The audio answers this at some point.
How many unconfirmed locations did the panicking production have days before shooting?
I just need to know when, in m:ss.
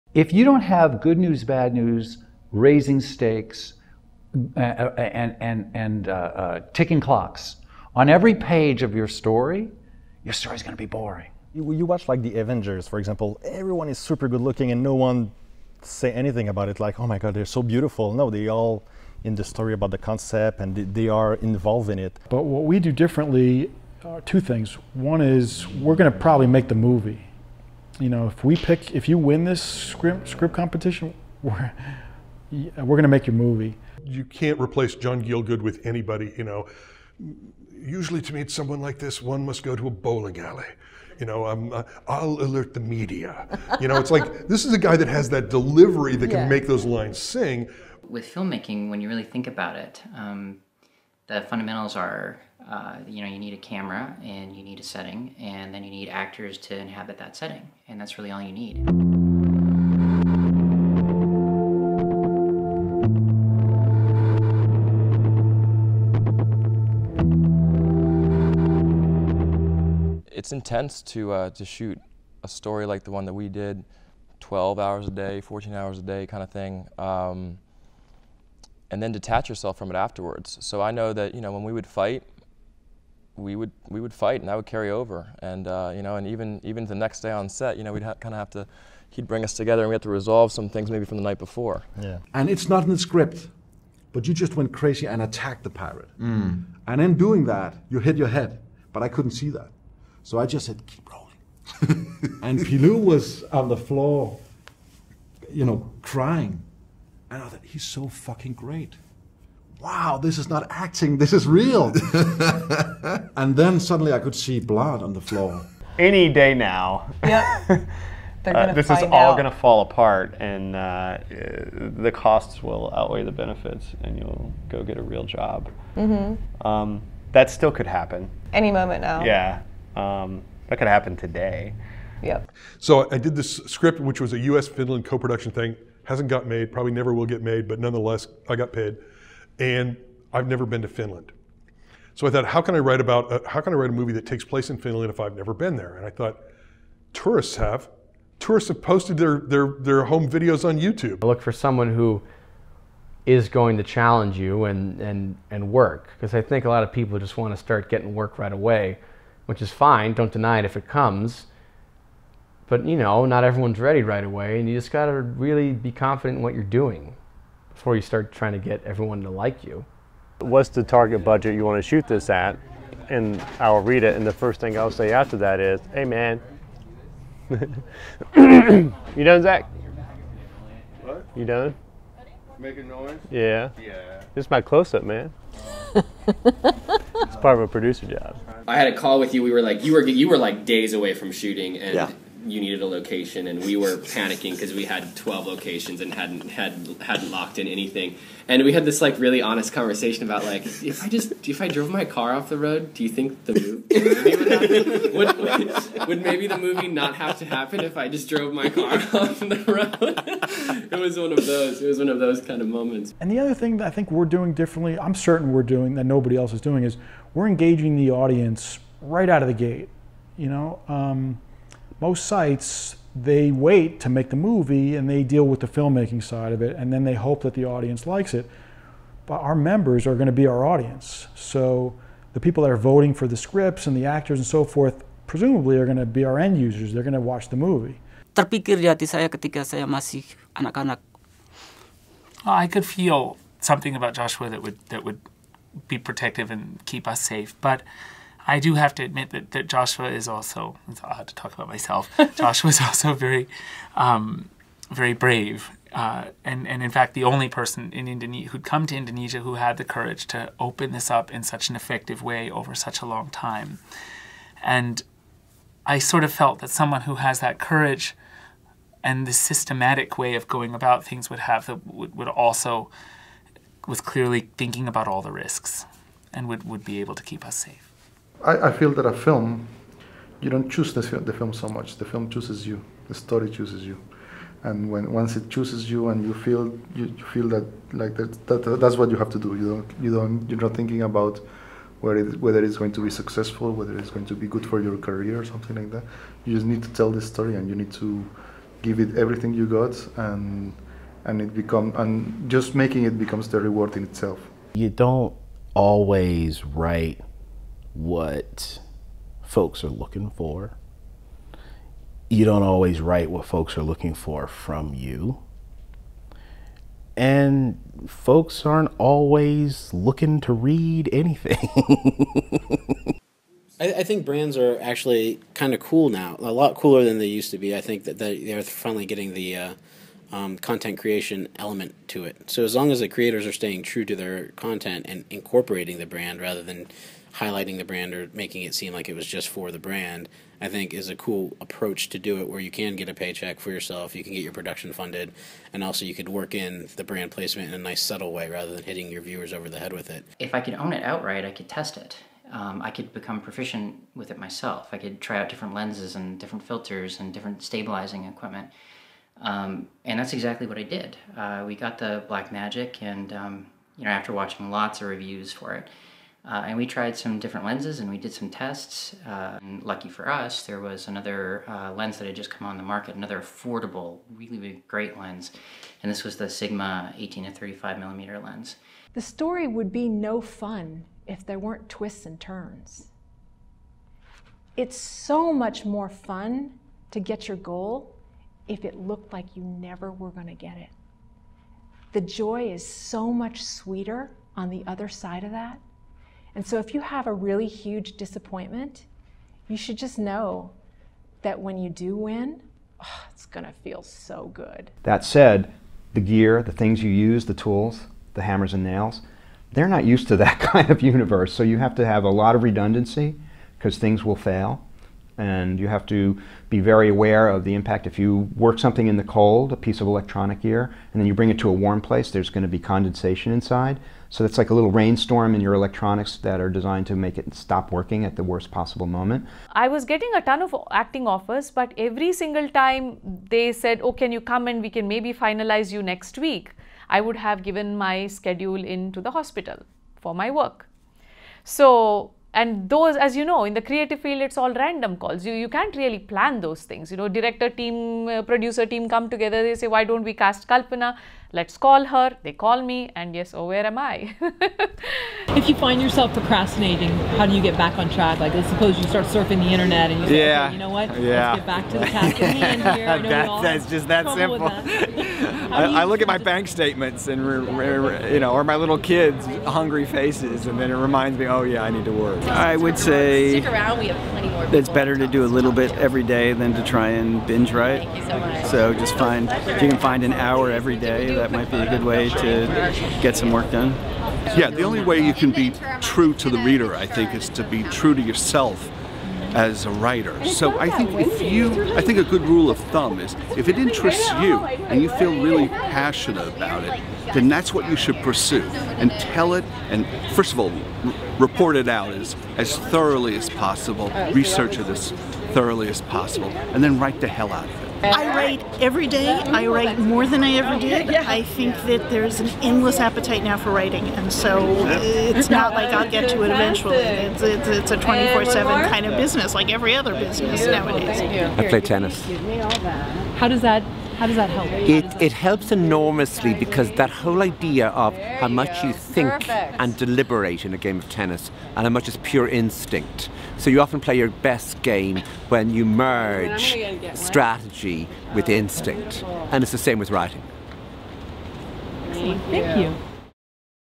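3:15.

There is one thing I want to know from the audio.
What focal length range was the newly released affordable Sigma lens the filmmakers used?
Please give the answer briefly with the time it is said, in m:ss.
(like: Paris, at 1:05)
18 to 35 millimeter, at 6:17.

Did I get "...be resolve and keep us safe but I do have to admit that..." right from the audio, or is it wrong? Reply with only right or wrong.
wrong.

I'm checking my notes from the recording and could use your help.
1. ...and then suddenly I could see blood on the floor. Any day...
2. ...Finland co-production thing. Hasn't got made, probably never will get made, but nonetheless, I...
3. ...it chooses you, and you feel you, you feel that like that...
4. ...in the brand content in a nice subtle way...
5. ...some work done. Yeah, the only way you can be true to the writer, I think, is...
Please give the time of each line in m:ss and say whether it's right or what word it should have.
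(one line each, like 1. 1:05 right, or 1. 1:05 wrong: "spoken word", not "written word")
1. 1:53 right
2. 2:14 right
3. 4:45 right
4. 5:46 wrong: "placement", not "content"
5. 8:03 wrong: "reader", not "writer".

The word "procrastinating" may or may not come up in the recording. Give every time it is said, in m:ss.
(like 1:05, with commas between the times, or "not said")
7:36.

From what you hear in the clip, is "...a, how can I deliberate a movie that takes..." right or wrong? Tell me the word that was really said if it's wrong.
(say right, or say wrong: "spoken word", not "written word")
wrong: "write", not "deliberate".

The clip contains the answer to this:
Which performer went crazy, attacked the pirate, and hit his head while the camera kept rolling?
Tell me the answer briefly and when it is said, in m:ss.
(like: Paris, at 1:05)
Pilou, at 1:42.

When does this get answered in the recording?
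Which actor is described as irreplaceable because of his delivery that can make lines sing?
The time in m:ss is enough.
0:34.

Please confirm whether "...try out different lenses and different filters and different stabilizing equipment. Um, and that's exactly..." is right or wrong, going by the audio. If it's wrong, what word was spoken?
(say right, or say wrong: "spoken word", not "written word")
right.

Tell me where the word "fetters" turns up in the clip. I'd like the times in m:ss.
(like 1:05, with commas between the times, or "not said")
not said.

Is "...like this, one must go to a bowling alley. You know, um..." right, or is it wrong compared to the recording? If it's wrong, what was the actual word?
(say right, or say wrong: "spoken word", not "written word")
right.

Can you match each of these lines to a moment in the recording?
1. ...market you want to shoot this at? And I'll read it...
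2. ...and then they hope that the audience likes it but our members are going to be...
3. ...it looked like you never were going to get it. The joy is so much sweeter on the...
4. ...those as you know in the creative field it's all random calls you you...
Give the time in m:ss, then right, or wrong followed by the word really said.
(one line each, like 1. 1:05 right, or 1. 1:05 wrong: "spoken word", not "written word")
1. 2:51 wrong: "budget", not "market"
2. 3:46 right
3. 6:28 right
4. 7:22 right.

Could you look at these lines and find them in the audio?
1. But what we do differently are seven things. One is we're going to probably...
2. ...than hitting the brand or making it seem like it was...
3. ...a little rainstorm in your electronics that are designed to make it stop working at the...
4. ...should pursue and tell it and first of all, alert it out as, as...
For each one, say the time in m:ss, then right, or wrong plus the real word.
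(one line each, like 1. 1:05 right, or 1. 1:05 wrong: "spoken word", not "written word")
1. 0:22 wrong: "two", not "seven"
2. 5:36 wrong: "highlighting", not "hitting"
3. 7:04 right
4. 8:17 wrong: "report", not "alert".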